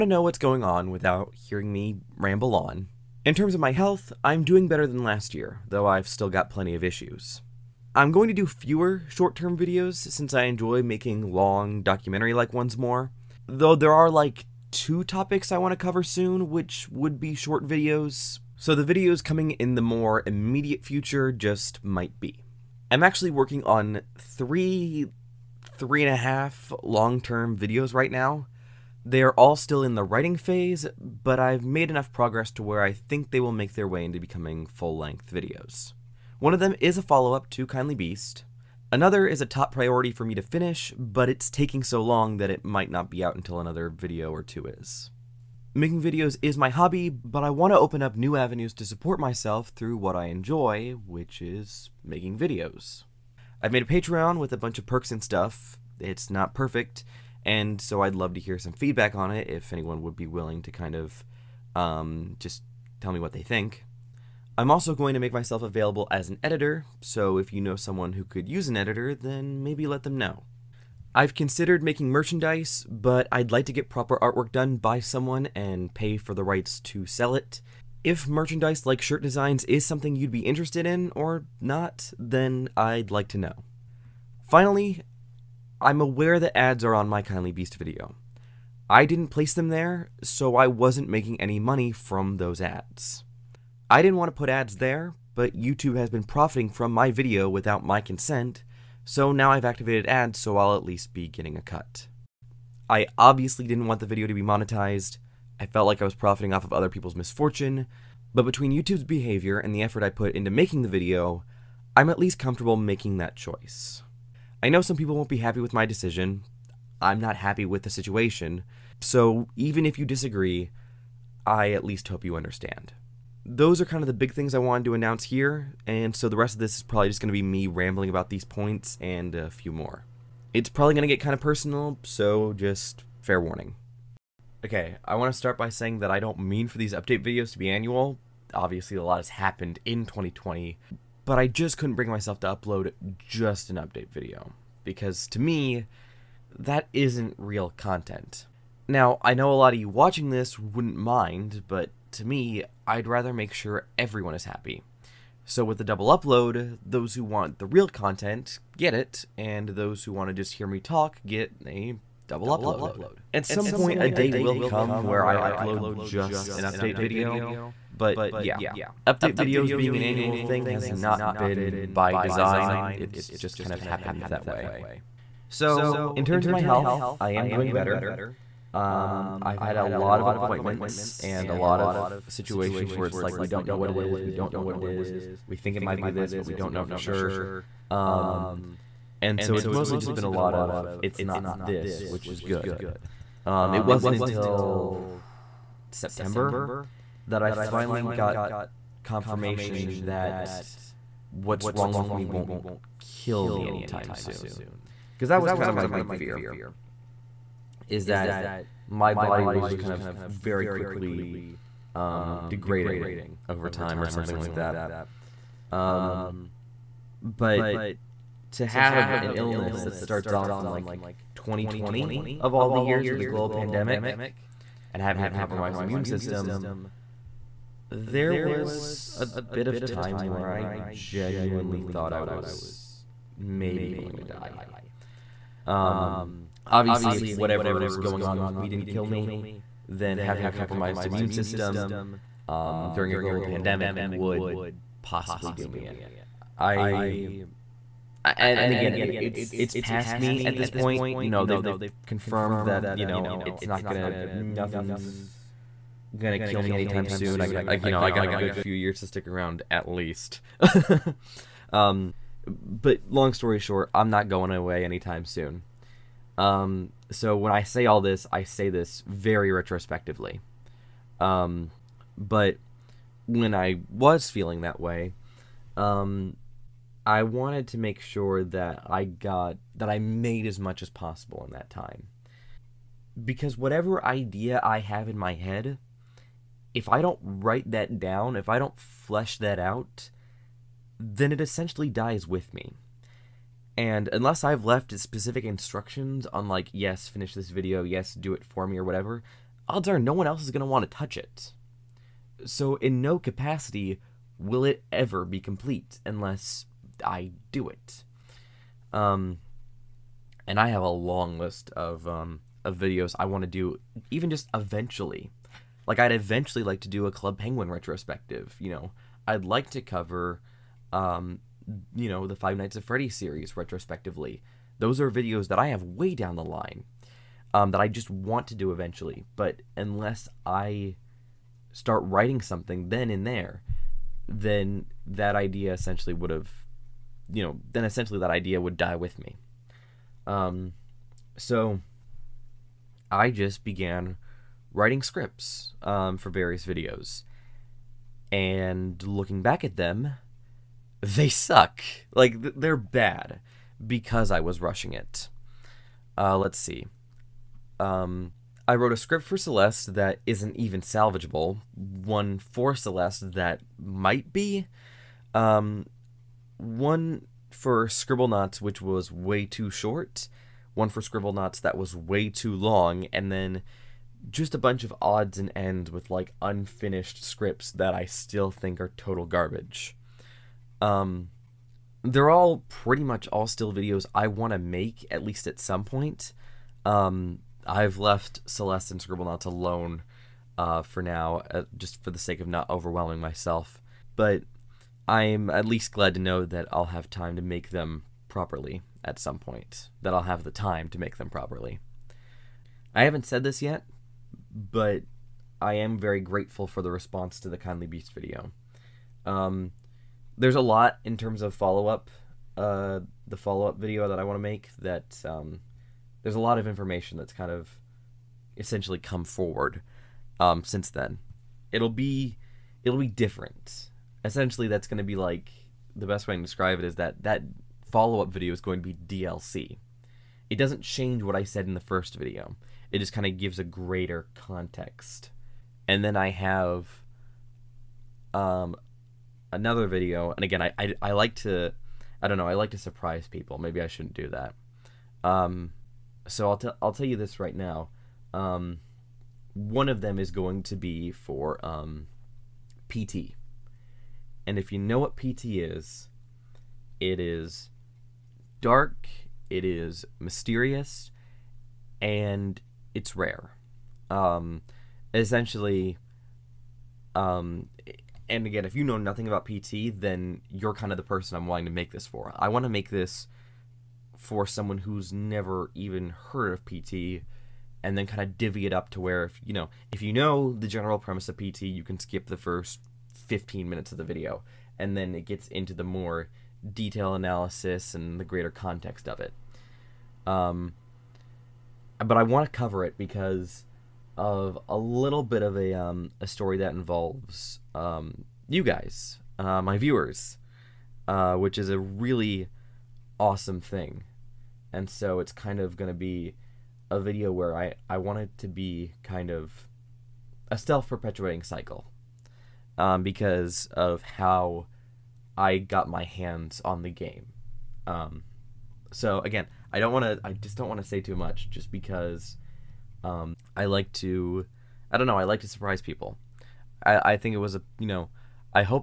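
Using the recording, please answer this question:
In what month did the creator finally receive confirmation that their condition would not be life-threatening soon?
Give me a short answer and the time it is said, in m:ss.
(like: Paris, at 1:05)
September, at 3:15.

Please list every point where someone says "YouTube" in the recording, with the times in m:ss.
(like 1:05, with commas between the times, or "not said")
1:35, 1:48.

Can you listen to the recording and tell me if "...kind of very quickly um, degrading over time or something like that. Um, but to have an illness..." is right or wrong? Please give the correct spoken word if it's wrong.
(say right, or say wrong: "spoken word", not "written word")
right.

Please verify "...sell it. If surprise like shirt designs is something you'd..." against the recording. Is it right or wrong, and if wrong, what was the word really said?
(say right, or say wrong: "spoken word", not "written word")
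wrong: "merchandise", not "surprise".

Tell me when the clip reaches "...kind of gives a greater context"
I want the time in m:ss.
7:13.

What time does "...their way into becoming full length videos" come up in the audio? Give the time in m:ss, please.
0:33.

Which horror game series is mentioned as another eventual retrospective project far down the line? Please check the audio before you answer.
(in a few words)
Five Nights at Freddy's.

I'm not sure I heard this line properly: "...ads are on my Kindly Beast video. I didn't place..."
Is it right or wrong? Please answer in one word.
right.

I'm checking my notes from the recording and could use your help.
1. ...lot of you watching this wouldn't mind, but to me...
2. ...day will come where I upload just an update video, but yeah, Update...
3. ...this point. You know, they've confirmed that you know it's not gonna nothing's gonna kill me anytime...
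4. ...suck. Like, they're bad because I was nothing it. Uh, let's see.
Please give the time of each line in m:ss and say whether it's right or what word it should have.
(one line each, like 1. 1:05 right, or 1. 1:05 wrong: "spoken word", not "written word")
1. 2:29 right
2. 2:44 right
3. 4:10 right
4. 5:51 wrong: "rushing", not "nothing".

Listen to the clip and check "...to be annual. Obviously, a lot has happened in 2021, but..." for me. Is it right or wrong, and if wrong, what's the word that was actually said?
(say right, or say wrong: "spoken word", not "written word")
wrong: "2020", not "2021".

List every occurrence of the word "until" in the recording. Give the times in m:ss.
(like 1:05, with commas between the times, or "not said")
0:43, 3:14.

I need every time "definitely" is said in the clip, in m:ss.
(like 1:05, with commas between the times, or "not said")
not said.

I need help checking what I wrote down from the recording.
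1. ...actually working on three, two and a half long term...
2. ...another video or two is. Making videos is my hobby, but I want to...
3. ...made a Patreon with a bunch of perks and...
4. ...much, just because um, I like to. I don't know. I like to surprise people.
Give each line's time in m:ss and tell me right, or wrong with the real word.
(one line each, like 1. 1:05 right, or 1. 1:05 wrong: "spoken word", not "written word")
1. 0:23 wrong: "three", not "two"
2. 0:43 right
3. 0:53 right
4. 8:41 right.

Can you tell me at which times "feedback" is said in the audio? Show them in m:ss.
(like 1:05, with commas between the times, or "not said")
0:58.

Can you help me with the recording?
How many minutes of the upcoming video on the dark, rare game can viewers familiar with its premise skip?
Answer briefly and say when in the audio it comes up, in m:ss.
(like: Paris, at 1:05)
15, at 8:03.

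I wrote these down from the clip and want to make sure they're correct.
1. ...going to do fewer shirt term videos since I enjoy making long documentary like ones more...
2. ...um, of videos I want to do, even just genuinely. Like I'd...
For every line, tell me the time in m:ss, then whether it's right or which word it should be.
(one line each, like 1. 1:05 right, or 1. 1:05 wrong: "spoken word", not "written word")
1. 0:08 wrong: "short", not "shirt"
2. 5:12 wrong: "eventually", not "genuinely".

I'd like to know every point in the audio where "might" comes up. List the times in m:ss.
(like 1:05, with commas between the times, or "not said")
0:21, 0:42, 3:05, 6:03.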